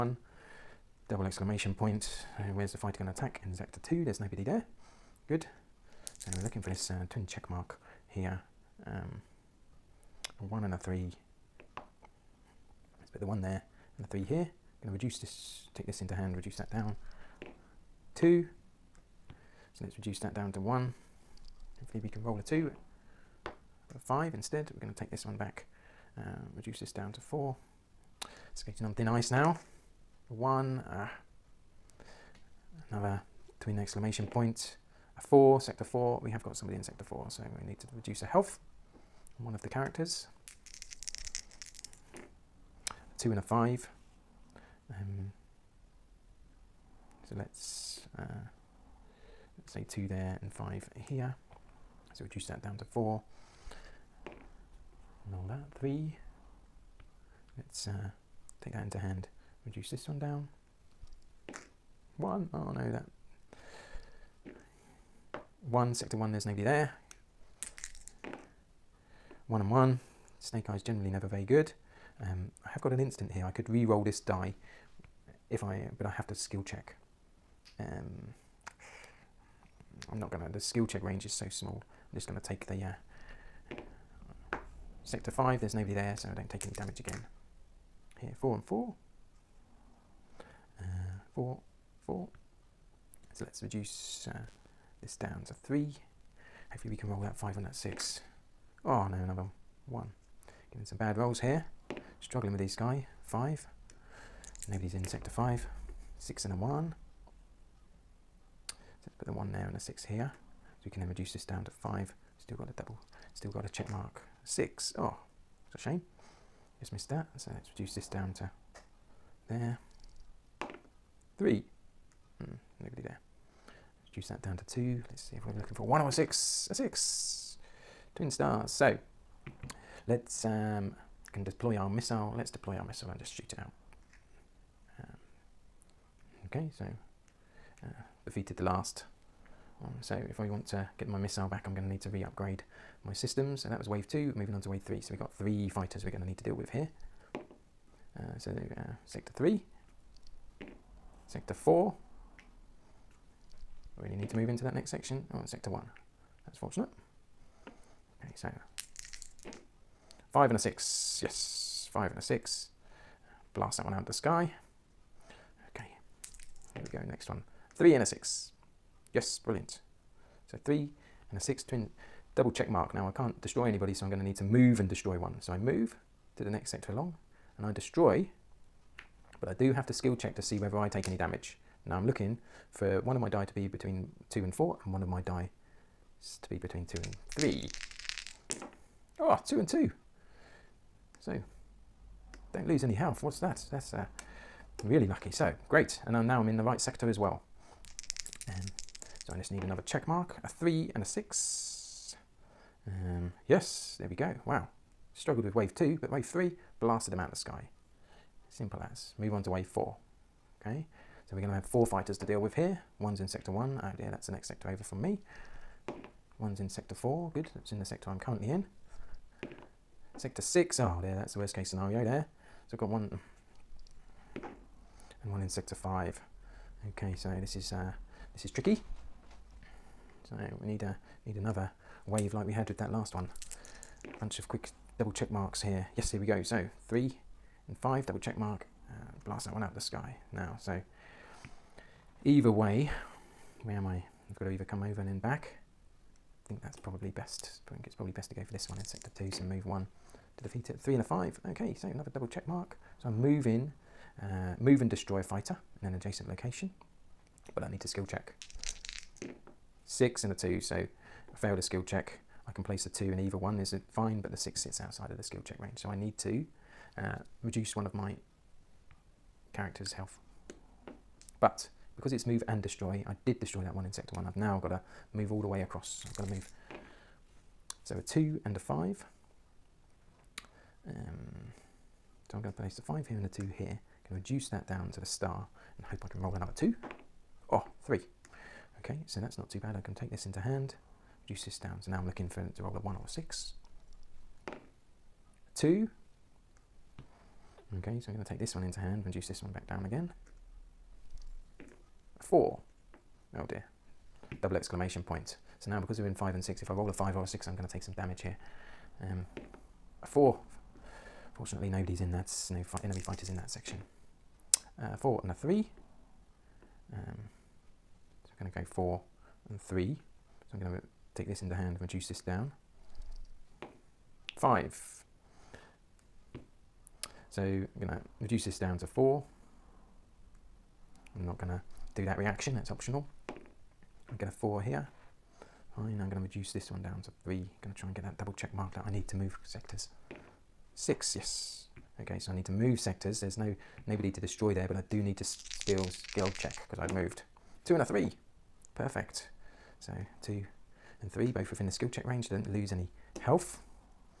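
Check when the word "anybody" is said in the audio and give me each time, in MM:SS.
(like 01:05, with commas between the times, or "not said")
02:53.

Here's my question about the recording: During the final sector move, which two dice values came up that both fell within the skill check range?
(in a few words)
2 and 3.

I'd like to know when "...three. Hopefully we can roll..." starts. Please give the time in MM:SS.
01:35.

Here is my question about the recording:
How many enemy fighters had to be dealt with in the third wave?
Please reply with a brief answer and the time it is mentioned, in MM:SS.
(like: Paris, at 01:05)
3, at 02:25.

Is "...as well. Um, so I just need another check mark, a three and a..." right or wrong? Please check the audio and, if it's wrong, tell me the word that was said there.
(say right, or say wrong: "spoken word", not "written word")
right.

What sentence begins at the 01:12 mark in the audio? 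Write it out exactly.
Um, I have got an instant here.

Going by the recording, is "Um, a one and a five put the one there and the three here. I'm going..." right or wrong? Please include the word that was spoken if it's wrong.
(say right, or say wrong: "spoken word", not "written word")
wrong: "three", not "five".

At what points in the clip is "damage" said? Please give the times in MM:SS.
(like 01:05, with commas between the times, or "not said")
01:26, 03:01, 05:07.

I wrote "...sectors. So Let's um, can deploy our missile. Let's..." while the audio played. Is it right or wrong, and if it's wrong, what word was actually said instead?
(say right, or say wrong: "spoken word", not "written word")
wrong: "stars", not "sectors".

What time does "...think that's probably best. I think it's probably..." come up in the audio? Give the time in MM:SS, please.
04:06.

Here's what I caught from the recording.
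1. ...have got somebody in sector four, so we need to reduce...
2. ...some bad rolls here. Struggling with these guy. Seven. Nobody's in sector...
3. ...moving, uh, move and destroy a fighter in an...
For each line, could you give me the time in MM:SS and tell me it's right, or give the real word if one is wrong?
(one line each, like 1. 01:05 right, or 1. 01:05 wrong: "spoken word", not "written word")
1. 00:36 right
2. 01:40 wrong: "Five", not "Seven"
3. 04:13 right.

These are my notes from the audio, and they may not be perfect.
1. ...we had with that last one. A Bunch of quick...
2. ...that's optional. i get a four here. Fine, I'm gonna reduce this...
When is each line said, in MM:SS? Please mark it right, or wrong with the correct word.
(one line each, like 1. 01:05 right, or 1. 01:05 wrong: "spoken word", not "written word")
1. 03:52 right
2. 05:32 right.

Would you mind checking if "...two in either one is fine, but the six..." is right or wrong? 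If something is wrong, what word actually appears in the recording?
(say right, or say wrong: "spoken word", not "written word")
right.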